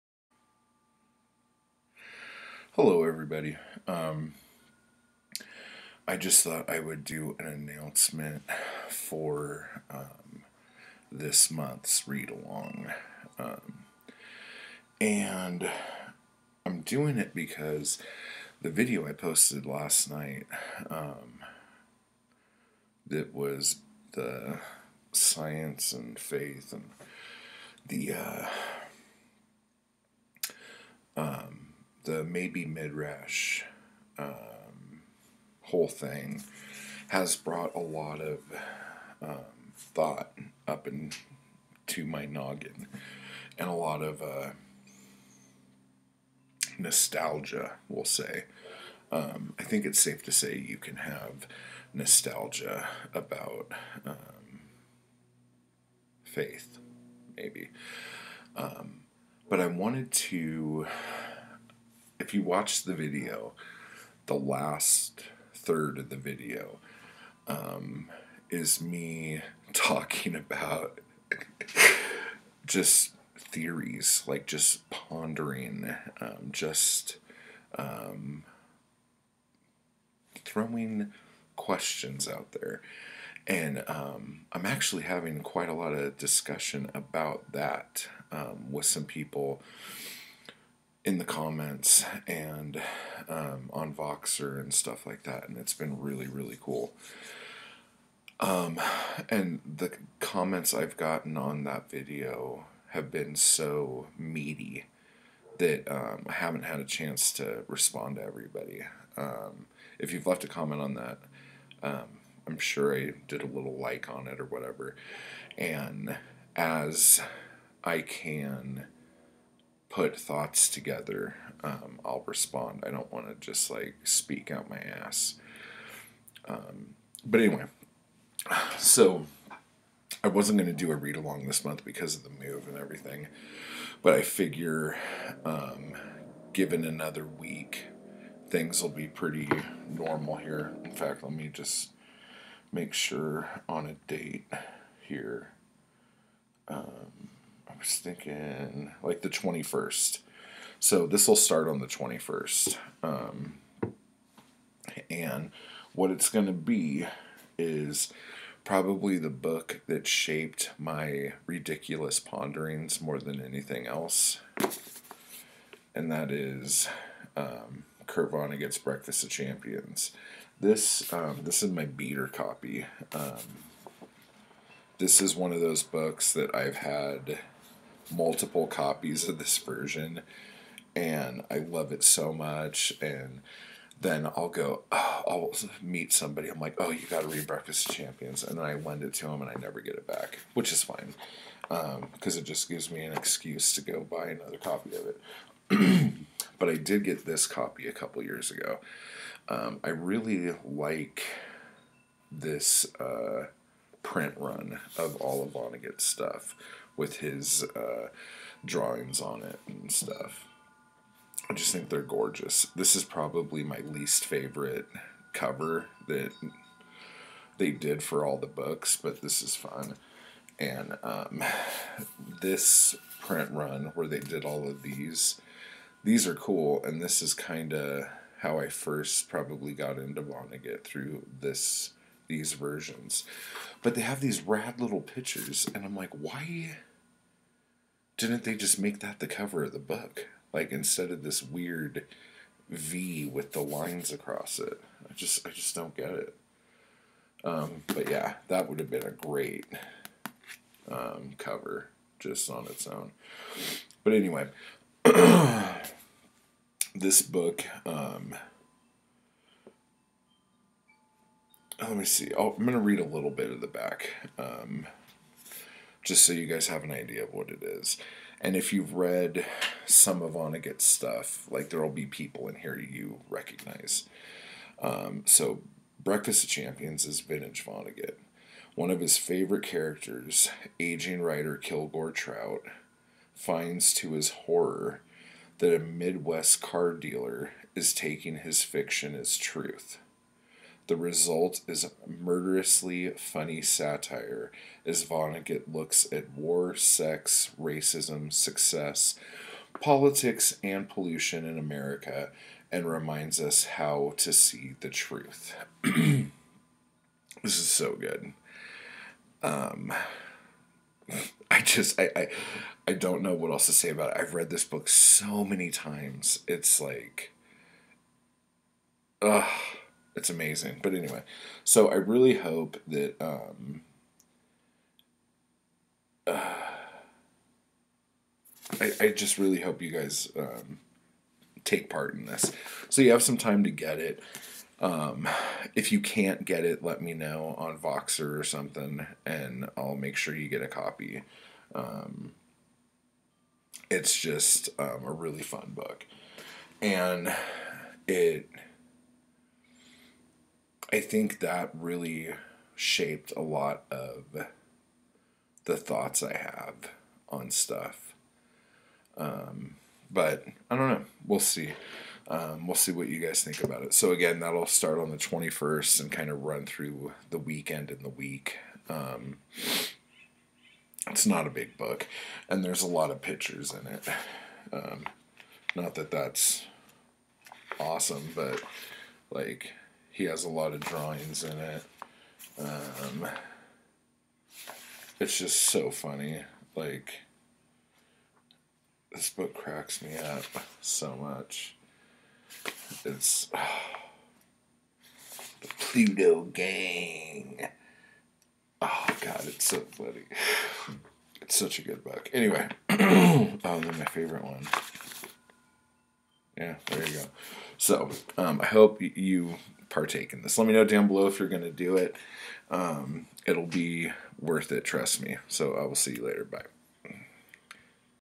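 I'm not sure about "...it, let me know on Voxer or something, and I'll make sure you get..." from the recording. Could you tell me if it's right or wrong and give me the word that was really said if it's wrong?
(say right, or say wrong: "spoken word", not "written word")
right.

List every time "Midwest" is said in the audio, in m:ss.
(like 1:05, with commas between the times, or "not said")
4:45.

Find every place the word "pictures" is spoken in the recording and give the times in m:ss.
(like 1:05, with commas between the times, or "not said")
3:55, 6:13.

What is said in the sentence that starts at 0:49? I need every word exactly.
Um, I think it's safe to say you can have nostalgia about um, faith, maybe.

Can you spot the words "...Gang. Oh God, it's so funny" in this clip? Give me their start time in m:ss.
6:36.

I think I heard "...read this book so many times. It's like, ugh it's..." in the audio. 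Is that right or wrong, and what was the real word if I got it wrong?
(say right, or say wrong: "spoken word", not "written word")
right.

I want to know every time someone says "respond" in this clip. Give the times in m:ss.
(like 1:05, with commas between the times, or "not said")
1:47, 2:02.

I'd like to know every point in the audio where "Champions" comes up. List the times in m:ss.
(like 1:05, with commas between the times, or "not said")
2:49, 3:07, 4:36.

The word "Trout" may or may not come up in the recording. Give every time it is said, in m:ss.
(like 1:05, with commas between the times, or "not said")
4:42.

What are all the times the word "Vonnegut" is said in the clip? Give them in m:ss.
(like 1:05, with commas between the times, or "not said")
2:48, 3:25, 3:50, 4:30, 4:37, 4:55.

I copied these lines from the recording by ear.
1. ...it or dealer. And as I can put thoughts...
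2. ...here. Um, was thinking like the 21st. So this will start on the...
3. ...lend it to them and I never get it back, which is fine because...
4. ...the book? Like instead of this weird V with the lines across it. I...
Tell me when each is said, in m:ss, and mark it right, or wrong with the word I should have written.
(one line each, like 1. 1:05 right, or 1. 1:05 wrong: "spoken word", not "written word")
1. 1:54 wrong: "whatever", not "dealer"
2. 2:25 right
3. 3:08 right
4. 3:59 right.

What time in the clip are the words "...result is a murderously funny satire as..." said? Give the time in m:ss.
4:50.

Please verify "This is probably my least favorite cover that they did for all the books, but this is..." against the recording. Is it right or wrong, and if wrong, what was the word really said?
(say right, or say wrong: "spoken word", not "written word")
right.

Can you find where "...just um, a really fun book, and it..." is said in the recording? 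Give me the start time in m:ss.
5:44.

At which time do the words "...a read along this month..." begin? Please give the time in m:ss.
2:10.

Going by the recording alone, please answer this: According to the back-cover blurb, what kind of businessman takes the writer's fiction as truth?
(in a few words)
car dealer.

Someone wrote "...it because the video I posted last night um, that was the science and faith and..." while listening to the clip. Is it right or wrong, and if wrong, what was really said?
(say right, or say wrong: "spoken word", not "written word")
right.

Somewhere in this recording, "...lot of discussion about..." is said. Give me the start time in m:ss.
1:25.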